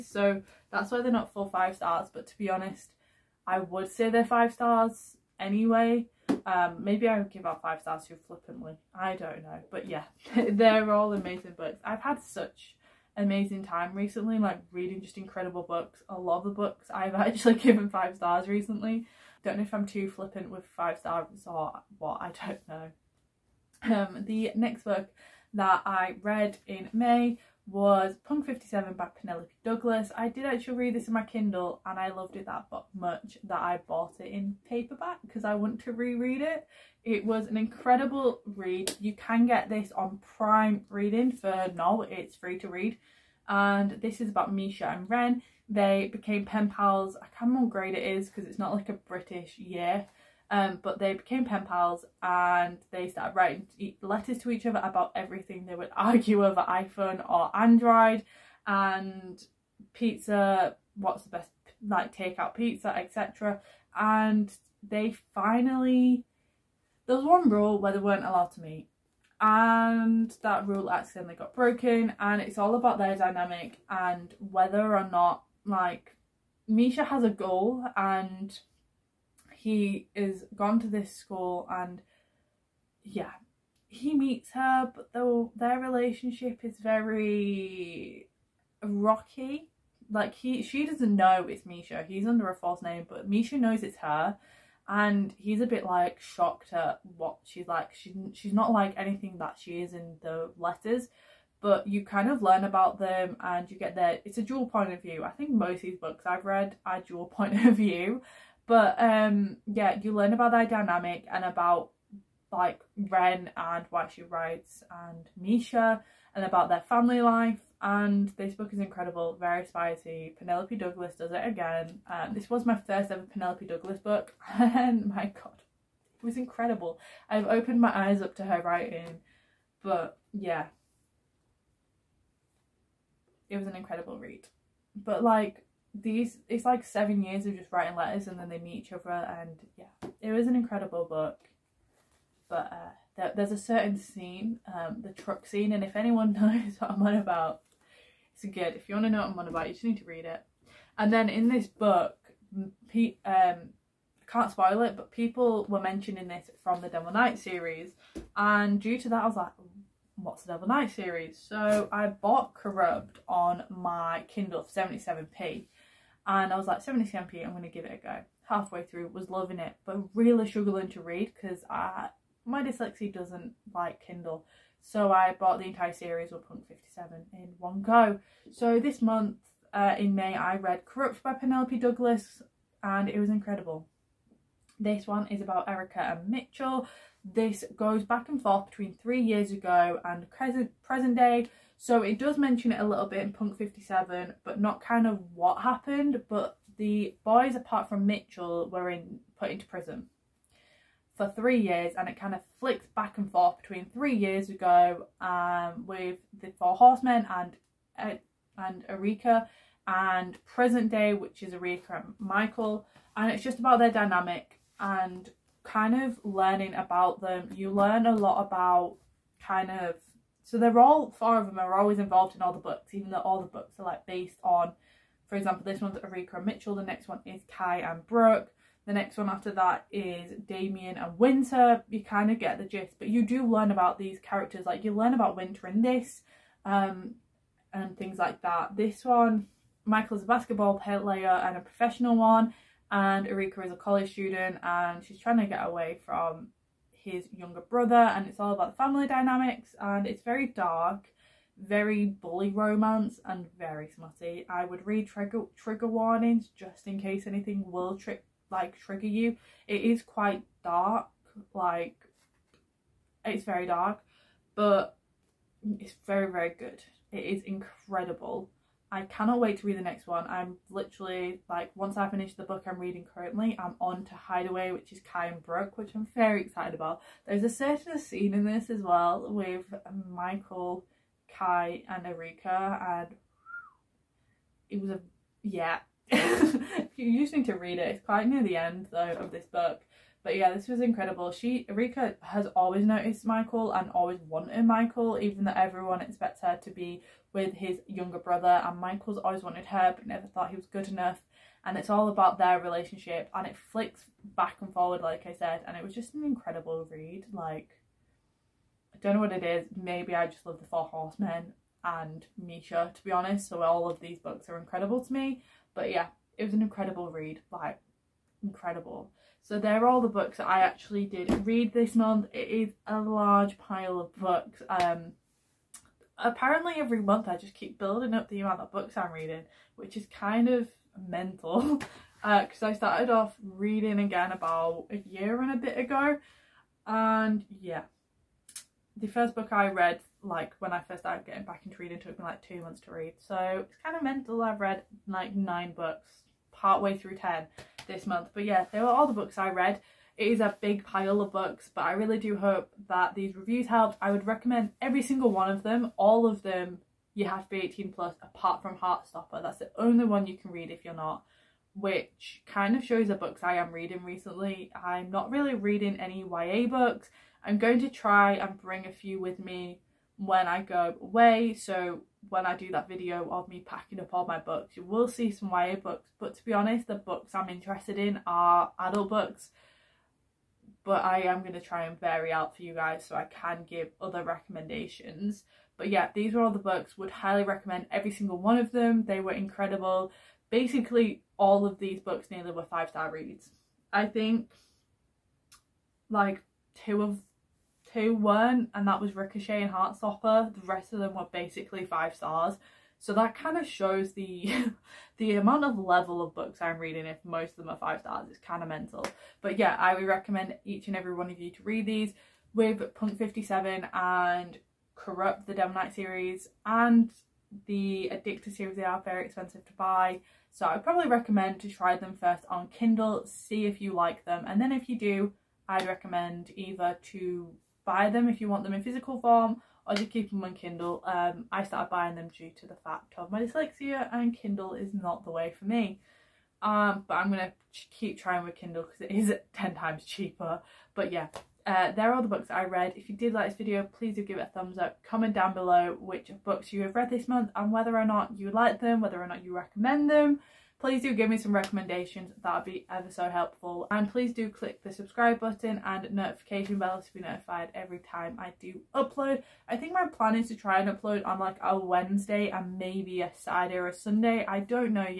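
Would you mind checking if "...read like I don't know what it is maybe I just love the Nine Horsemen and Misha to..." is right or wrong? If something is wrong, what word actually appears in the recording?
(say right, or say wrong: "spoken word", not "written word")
wrong: "Four", not "Nine".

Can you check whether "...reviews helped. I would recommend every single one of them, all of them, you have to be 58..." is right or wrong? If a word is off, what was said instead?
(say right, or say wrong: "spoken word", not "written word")
wrong: "18", not "58".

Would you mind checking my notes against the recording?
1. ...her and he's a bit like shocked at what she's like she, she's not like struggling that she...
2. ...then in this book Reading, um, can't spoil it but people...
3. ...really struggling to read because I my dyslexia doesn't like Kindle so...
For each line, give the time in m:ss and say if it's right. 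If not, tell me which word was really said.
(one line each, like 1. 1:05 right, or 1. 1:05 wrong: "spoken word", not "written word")
1. 1:34 wrong: "anything", not "struggling"
2. 2:31 wrong: "Pete", not "Reading"
3. 2:50 right.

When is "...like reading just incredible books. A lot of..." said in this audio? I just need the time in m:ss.
0:14.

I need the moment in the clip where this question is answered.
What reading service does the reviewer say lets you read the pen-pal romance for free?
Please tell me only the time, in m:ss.
0:40.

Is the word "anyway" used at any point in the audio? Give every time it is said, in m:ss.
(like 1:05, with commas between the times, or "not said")
0:05.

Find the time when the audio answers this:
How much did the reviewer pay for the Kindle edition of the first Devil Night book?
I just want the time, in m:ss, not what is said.
2:44.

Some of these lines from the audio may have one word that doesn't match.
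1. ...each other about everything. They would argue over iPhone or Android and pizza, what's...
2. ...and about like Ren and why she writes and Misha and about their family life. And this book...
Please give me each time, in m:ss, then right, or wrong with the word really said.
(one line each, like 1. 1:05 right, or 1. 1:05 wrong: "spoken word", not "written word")
1. 0:54 right
2. 1:51 right.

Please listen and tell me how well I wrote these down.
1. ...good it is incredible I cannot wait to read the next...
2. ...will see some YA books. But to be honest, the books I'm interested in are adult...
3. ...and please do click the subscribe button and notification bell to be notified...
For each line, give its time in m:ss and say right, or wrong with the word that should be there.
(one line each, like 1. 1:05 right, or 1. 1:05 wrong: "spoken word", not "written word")
1. 4:26 right
2. 6:14 right
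3. 7:33 right.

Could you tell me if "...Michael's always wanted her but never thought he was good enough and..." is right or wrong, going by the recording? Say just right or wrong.
right.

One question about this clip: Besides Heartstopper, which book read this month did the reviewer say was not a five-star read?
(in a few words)
Ricochet.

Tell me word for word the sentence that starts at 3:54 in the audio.
Like you learn about Winter in this um, and things like that.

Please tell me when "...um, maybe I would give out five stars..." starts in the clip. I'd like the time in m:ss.
0:06.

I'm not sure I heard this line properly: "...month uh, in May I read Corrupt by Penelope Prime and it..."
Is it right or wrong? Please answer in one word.
wrong.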